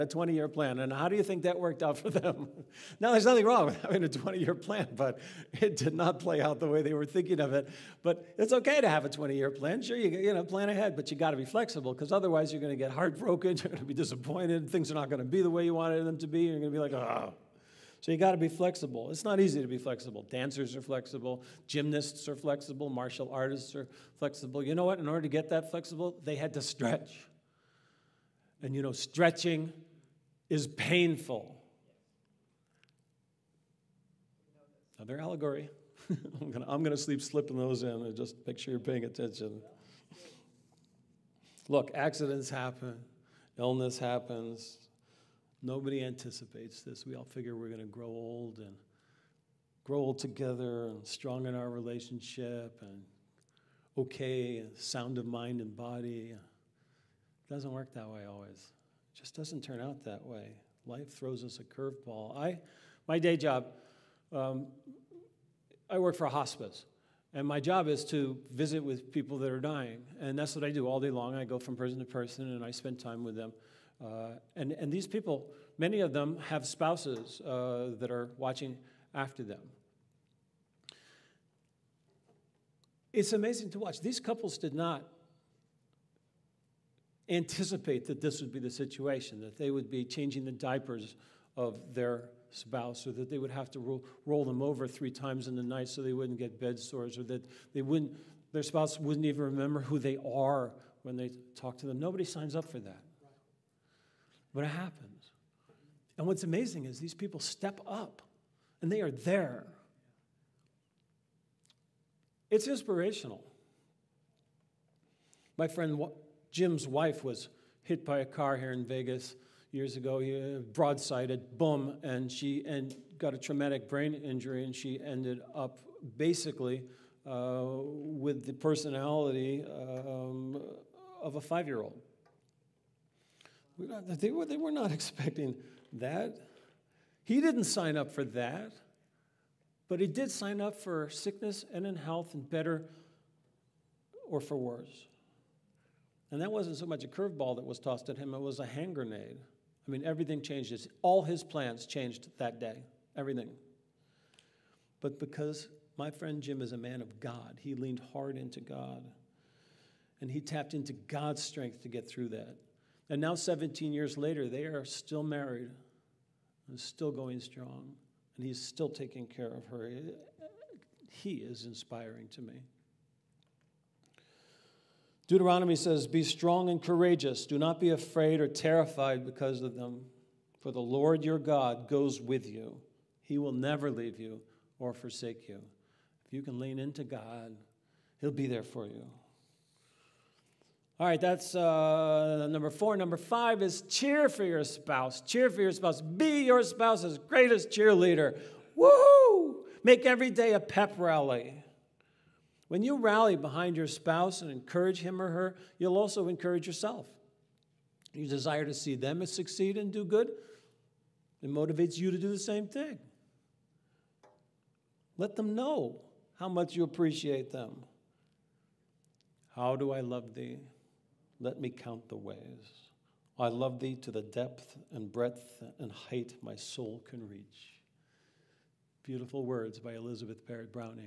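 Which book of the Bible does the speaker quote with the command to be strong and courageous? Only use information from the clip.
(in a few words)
Deuteronomy.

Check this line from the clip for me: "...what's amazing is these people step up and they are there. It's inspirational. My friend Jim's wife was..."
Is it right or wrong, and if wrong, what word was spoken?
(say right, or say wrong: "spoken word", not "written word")
right.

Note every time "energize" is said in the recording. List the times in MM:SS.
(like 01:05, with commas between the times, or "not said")
not said.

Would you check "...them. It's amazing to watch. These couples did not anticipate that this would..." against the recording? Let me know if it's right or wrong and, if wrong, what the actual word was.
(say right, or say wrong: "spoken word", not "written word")
right.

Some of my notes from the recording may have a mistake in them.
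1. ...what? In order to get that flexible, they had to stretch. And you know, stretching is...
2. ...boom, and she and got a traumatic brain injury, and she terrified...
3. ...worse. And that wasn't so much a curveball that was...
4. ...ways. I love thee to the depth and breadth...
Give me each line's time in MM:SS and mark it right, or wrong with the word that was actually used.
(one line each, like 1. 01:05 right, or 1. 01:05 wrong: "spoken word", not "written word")
1. 00:24 right
2. 02:01 wrong: "ended", not "terrified"
3. 02:24 right
4. 03:42 right.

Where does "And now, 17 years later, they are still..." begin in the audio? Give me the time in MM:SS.
02:43.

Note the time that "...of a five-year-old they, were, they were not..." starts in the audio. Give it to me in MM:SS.
02:11.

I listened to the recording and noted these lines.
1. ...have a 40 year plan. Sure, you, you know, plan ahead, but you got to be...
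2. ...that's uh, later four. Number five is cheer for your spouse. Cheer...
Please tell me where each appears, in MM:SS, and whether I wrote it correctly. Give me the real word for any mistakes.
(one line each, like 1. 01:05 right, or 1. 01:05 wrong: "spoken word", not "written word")
1. 00:08 wrong: "20", not "40"
2. 03:11 wrong: "number", not "later".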